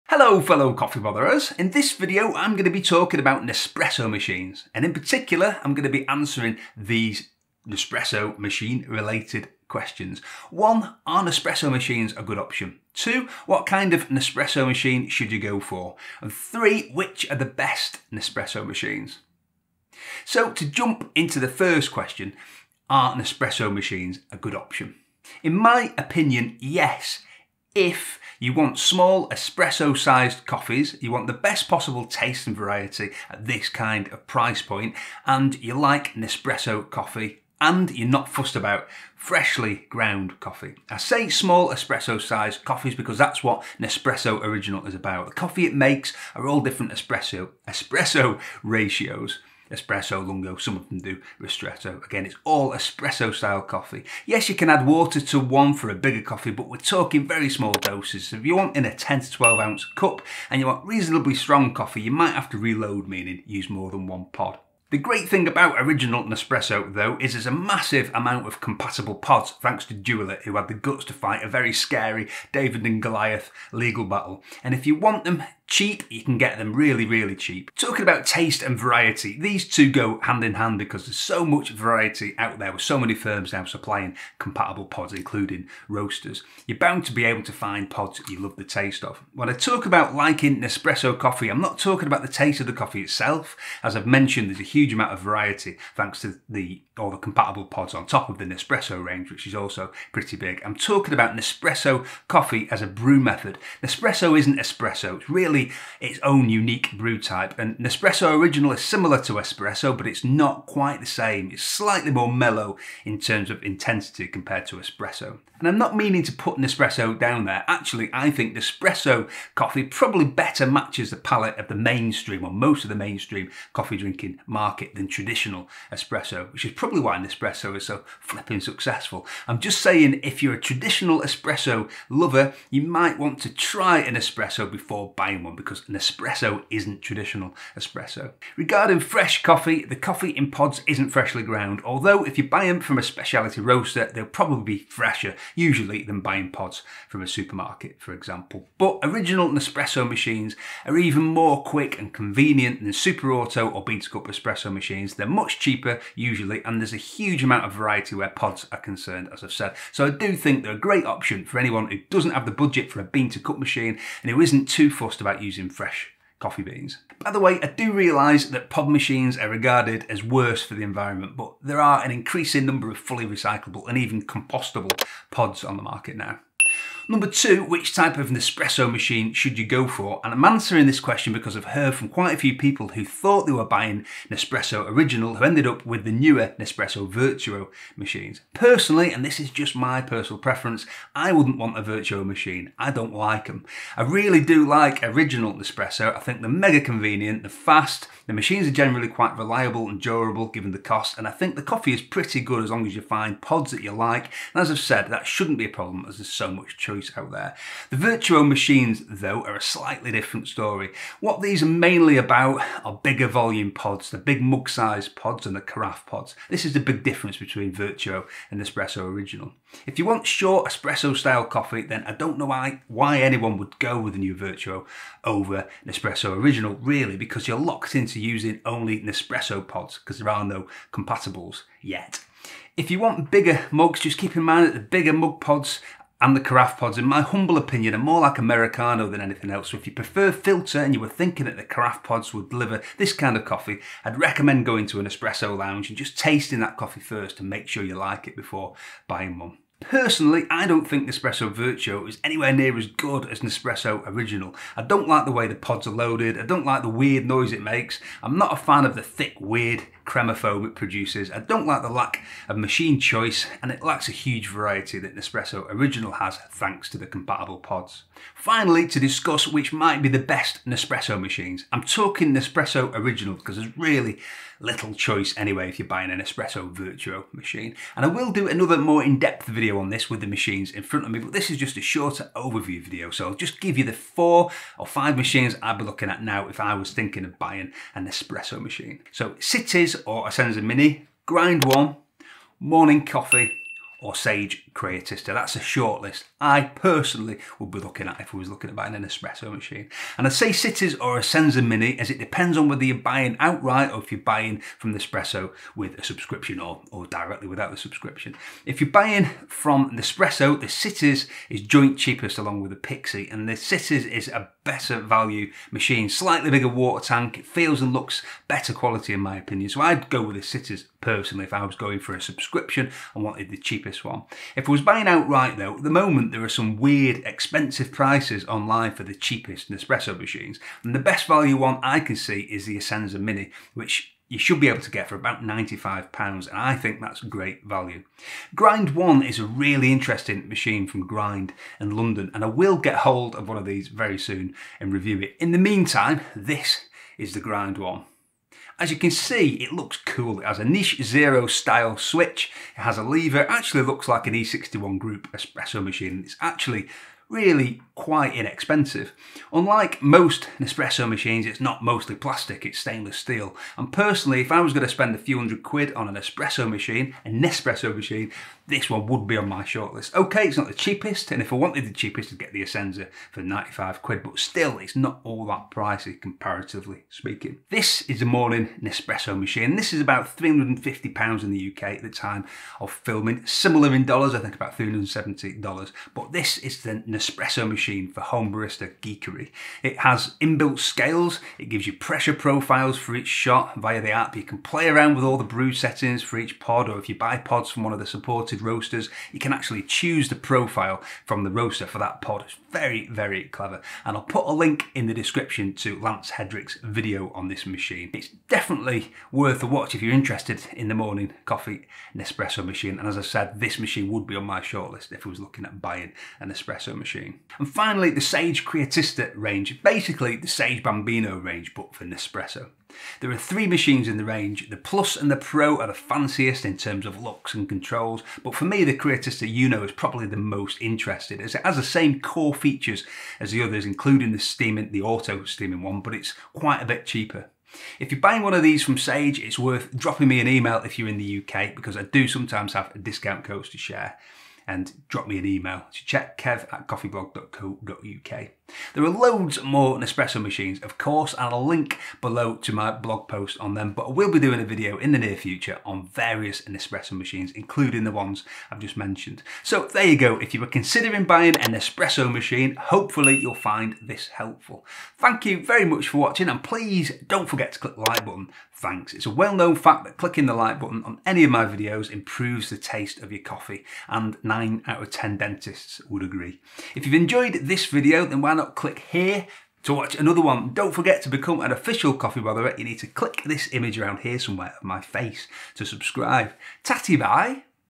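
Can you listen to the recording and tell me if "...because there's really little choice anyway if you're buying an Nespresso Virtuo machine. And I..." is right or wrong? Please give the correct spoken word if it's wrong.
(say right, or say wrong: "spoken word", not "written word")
right.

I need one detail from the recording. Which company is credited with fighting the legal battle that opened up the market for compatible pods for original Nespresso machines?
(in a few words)
Dualit.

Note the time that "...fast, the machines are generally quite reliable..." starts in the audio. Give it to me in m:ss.
3:17.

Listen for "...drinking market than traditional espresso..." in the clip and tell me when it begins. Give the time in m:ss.
2:03.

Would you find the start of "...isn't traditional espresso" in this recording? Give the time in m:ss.
2:16.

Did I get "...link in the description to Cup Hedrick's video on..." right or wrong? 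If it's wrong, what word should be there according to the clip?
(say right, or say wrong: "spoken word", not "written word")
wrong: "Lance", not "Cup".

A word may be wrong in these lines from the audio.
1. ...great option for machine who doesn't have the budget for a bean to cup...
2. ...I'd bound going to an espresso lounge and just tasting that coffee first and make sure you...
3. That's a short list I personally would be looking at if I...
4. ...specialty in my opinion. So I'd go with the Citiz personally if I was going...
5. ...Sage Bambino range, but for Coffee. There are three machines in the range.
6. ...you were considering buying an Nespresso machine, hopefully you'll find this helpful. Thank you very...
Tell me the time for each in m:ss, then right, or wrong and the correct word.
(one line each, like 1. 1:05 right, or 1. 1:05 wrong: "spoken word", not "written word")
1. 2:40 wrong: "anyone", not "machine"
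2. 4:04 wrong: "recommend", not "bound"
3. 4:55 right
4. 5:18 wrong: "quality", not "specialty"
5. 7:00 wrong: "Nespresso", not "Coffee"
6. 7:40 right.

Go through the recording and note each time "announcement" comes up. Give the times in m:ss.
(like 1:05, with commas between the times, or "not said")
not said.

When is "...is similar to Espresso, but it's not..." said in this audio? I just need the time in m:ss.
1:48.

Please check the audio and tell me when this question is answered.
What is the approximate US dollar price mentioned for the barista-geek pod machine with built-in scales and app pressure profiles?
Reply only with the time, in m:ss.
6:24.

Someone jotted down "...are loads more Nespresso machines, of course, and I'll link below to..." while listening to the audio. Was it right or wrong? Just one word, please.
right.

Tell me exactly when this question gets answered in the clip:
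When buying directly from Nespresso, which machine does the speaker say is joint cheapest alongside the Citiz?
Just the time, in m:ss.
5:12.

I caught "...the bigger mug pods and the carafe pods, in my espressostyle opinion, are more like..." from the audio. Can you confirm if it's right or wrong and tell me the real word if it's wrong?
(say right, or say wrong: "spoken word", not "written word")
wrong: "humble", not "espressostyle".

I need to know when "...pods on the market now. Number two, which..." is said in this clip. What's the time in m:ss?
2:55.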